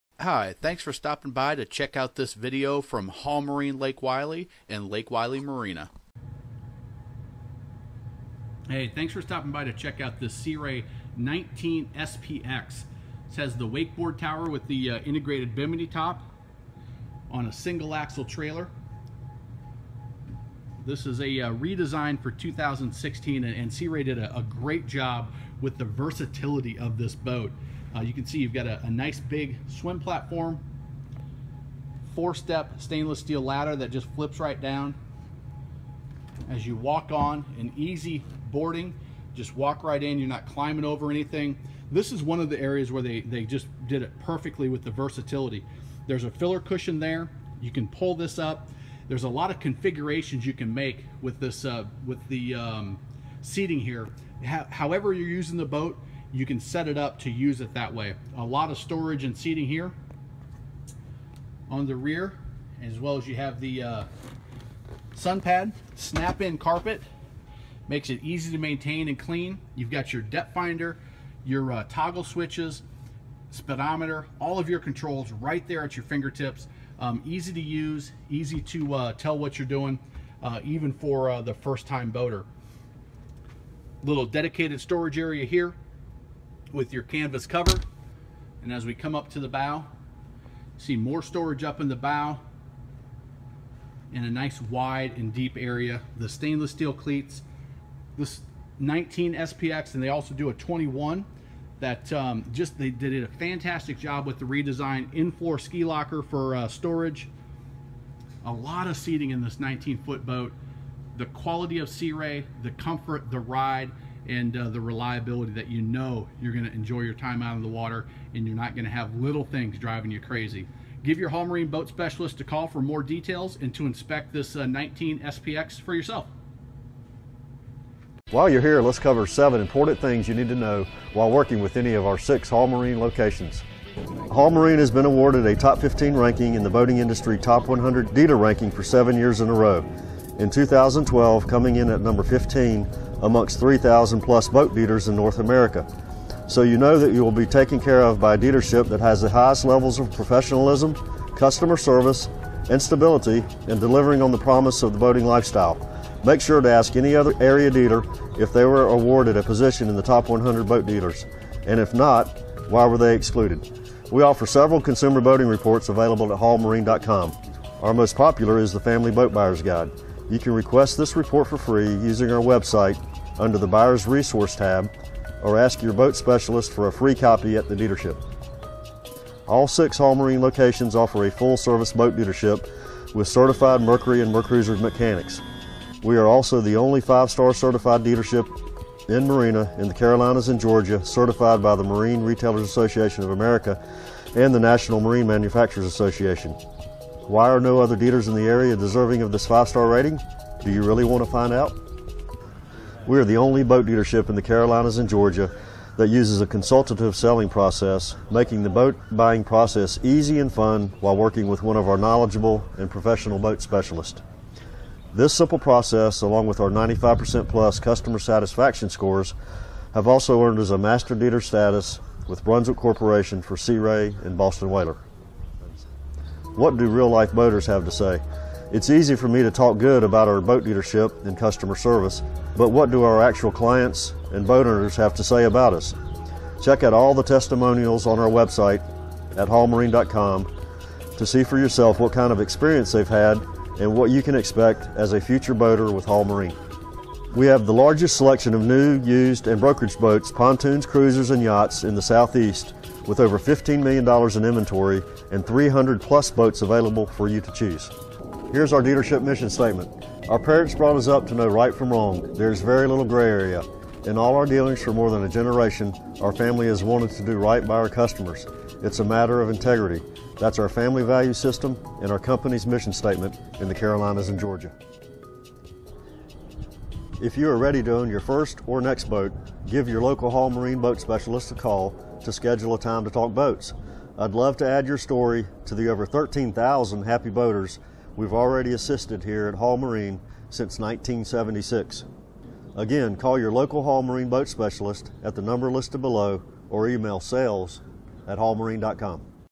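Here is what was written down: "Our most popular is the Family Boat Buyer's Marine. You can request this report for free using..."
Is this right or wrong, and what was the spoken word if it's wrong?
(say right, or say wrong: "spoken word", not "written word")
wrong: "Guide", not "Marine".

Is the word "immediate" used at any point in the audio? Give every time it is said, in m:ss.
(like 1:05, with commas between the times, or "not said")
not said.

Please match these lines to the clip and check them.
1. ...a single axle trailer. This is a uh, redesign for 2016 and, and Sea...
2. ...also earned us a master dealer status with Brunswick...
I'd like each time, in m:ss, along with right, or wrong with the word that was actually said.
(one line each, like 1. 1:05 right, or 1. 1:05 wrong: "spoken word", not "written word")
1. 0:17 right
2. 3:40 right.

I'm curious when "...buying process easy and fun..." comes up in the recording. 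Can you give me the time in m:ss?
3:29.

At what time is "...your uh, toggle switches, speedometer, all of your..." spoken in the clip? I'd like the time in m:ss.
1:11.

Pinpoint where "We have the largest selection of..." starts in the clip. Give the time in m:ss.
4:07.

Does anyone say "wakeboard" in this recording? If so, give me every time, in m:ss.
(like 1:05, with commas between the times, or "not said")
0:13.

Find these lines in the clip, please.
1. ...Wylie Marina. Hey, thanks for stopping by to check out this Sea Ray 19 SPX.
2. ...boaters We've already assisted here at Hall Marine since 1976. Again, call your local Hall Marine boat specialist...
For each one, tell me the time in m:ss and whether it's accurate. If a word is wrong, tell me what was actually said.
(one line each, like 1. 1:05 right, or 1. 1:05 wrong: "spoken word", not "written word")
1. 0:05 right
2. 4:47 right.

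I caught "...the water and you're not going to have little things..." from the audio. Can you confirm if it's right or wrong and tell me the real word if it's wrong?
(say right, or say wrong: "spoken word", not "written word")
right.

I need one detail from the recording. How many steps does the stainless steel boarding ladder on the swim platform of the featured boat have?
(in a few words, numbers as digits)
4.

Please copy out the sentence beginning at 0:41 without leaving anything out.
This is one of the areas where they, they just did it perfectly with the versatility.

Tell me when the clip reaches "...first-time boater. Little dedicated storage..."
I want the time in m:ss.
1:21.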